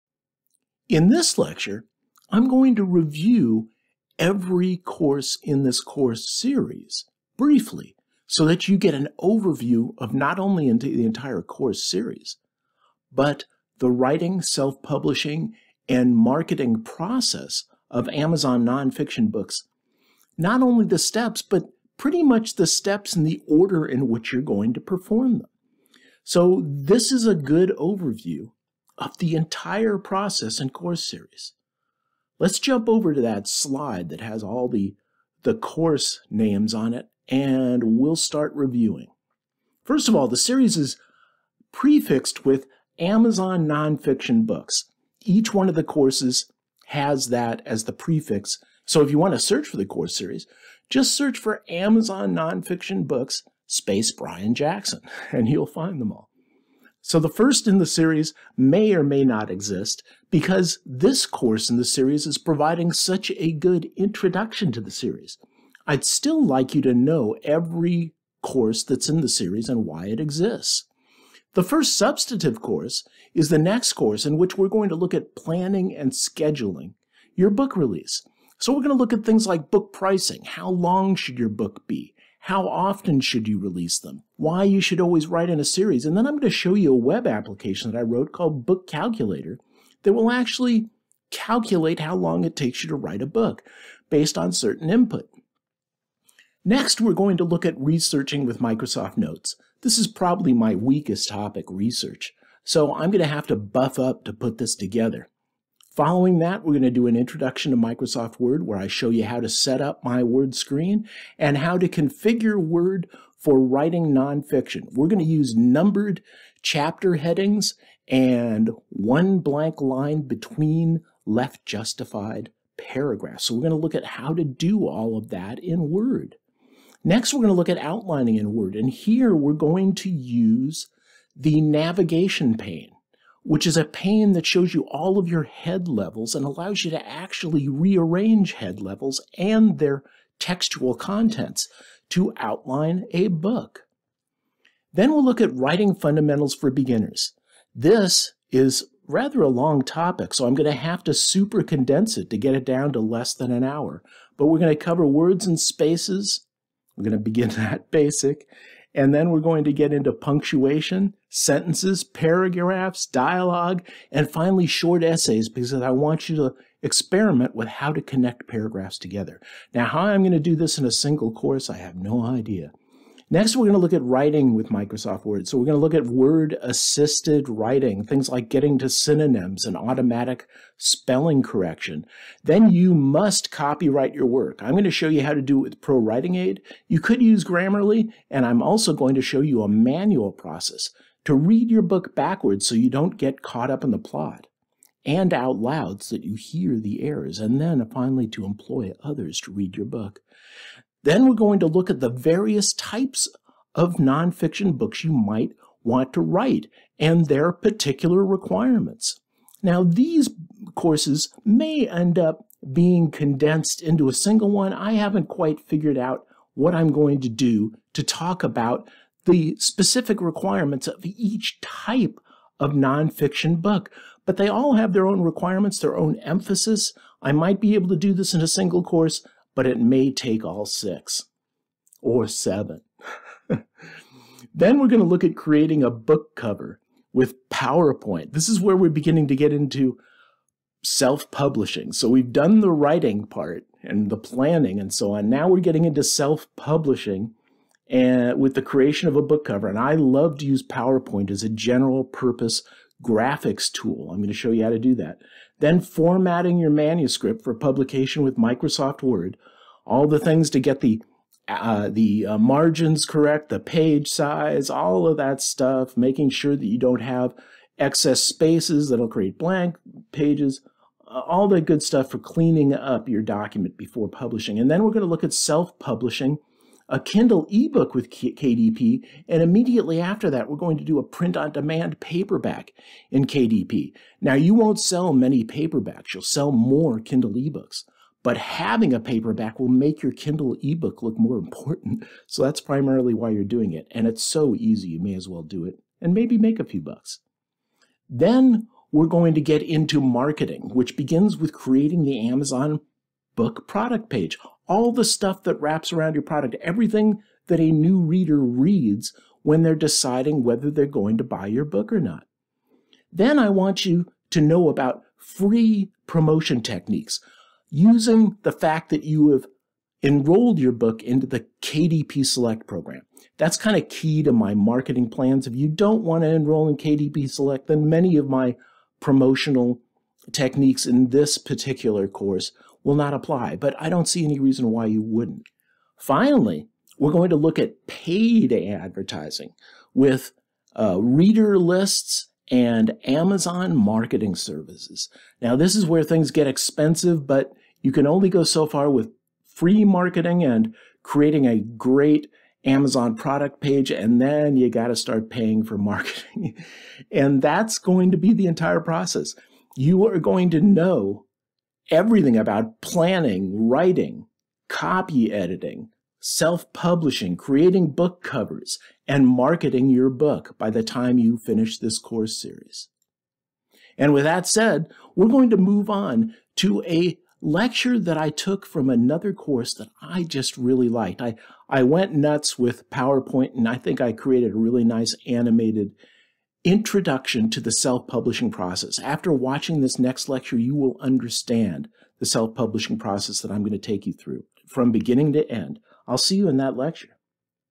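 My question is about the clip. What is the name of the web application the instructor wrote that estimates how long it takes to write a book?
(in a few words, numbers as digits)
Book Calculator.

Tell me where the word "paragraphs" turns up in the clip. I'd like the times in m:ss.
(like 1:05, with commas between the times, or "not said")
2:02, 2:42, 2:48.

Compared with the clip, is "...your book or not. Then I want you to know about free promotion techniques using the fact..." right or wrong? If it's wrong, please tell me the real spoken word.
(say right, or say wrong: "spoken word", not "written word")
right.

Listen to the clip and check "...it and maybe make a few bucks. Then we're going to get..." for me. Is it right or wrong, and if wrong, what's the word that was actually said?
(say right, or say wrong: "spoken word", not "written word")
right.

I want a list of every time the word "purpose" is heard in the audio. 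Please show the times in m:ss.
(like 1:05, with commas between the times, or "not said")
4:12.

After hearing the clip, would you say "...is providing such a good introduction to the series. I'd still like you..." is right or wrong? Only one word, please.
right.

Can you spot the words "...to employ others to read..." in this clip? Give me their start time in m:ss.
3:18.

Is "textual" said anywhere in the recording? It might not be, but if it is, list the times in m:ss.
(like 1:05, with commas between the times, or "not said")
2:20.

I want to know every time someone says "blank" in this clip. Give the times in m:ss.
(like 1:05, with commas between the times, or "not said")
1:59, 4:29.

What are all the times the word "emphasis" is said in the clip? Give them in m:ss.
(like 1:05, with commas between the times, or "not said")
3:46.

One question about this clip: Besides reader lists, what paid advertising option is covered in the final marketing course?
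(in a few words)
Amazon marketing services.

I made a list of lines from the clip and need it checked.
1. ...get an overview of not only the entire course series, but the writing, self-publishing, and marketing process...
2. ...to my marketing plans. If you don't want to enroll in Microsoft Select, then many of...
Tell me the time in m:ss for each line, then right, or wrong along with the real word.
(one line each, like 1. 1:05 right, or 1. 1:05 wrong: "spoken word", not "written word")
1. 0:08 right
2. 5:24 wrong: "KDP", not "Microsoft".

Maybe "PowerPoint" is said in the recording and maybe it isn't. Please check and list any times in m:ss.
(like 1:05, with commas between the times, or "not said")
3:57, 4:10, 6:22.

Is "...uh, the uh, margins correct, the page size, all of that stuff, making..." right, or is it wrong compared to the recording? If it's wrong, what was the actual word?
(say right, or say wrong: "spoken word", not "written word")
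right.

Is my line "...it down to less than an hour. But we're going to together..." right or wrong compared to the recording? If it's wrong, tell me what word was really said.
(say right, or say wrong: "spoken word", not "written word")
wrong: "cover", not "together".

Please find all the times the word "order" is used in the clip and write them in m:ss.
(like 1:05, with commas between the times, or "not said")
0:23.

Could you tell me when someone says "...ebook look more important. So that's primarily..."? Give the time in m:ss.
4:50.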